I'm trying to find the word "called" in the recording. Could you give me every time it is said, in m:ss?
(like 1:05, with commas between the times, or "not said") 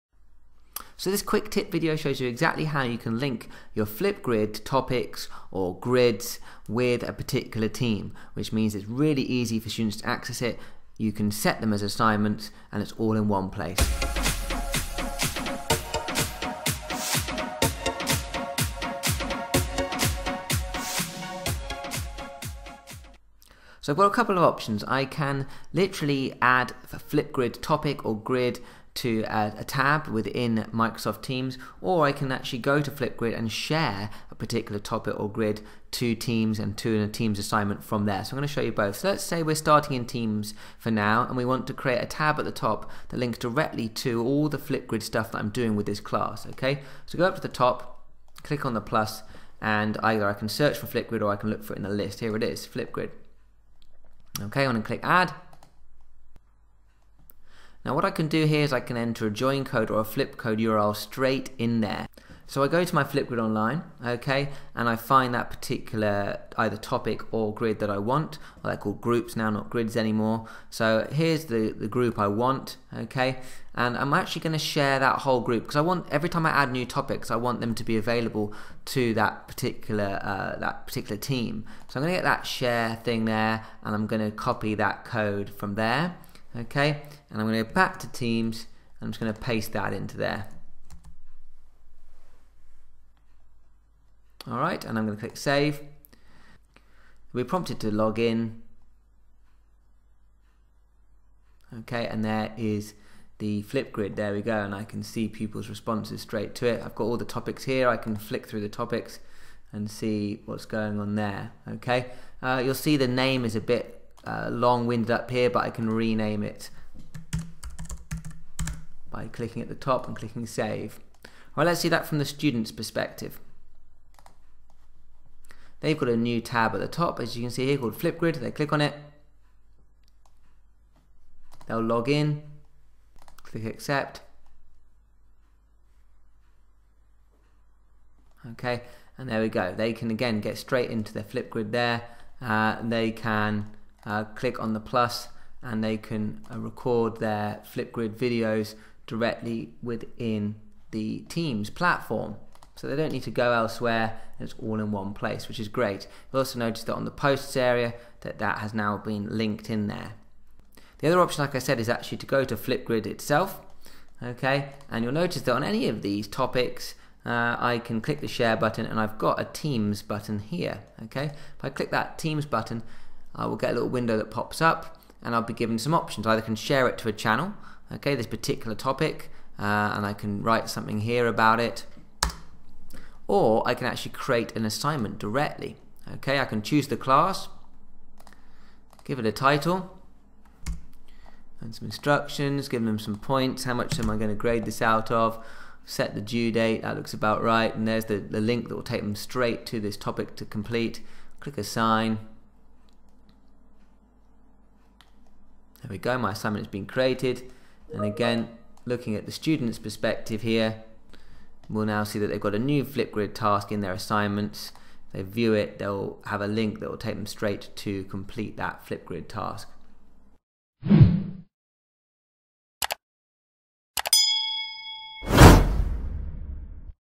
1:08, 2:07.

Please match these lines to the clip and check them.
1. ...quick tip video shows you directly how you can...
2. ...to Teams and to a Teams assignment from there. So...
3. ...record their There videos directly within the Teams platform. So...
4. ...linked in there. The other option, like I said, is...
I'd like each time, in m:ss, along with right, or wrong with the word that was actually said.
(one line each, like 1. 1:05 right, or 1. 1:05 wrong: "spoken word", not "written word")
1. 0:01 wrong: "exactly", not "directly"
2. 0:35 right
3. 2:26 wrong: "Flipgrid", not "There"
4. 2:39 right.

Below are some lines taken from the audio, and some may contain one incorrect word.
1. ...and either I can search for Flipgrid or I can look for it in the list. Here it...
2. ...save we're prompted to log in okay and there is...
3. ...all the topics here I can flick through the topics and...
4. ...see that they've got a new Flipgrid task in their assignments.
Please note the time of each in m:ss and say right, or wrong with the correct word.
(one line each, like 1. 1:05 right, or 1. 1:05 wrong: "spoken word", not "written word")
1. 0:49 right
2. 1:35 right
3. 1:47 right
4. 3:32 right.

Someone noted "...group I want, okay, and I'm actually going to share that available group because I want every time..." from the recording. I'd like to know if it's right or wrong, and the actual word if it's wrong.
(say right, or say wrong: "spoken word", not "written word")
wrong: "whole", not "available".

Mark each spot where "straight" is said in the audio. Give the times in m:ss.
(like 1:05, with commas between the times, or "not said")
1:00, 1:46, 2:20, 3:19, 3:37.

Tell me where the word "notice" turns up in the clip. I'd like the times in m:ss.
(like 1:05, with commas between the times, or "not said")
2:36, 2:45.